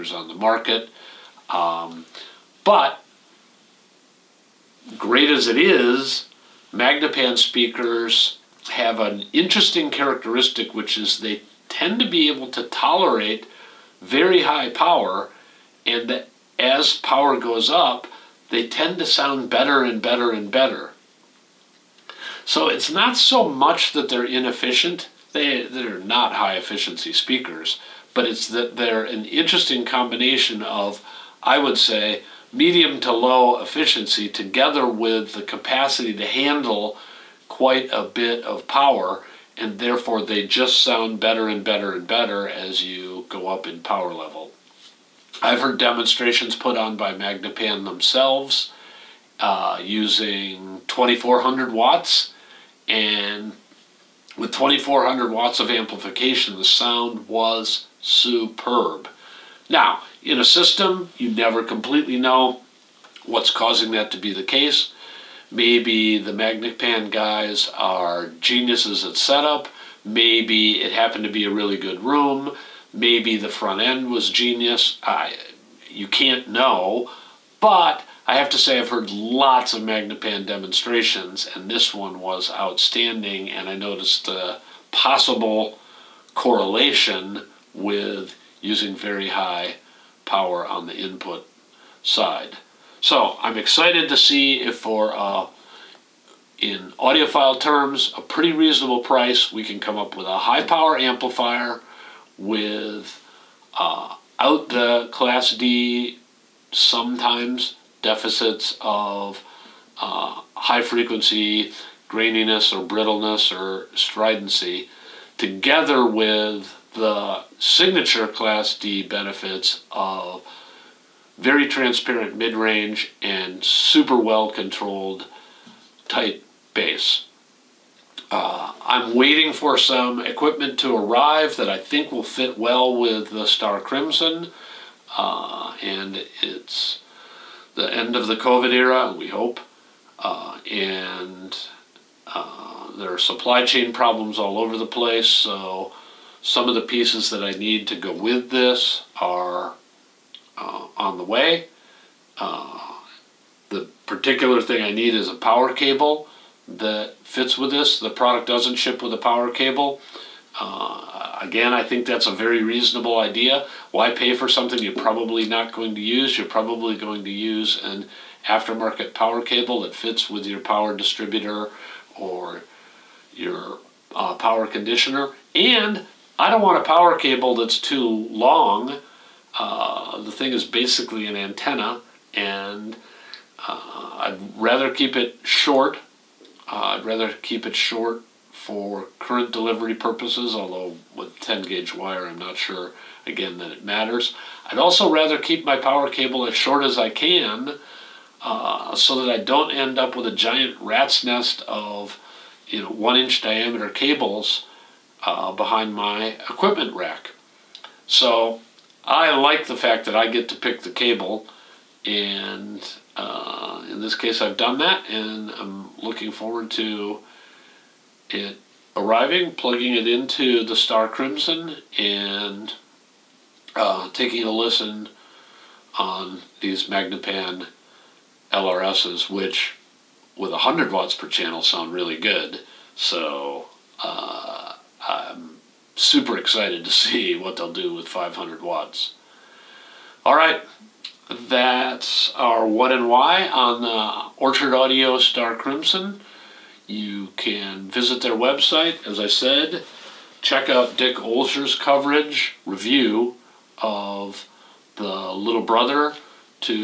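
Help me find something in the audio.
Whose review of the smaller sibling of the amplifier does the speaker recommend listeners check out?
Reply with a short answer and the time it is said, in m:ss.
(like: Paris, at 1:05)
Dick Olsher, at 4:10.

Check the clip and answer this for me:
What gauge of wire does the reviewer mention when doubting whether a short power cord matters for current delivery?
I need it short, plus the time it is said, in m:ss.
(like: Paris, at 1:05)
10 gauge, at 3:11.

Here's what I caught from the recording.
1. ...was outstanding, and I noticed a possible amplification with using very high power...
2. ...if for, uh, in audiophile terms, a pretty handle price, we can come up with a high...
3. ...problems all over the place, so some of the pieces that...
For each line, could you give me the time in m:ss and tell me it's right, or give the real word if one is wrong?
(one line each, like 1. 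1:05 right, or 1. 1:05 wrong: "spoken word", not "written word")
1. 1:22 wrong: "correlation", not "amplification"
2. 1:34 wrong: "reasonable", not "handle"
3. 2:23 right.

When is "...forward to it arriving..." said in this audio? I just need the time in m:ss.
3:36.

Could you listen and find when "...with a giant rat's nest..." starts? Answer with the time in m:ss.
3:20.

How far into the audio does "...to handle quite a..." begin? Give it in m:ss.
0:36.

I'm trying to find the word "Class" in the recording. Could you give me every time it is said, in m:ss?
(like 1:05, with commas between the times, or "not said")
1:45, 1:58.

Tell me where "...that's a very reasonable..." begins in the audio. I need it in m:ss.
2:42.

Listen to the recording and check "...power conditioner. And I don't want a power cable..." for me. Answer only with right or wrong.
right.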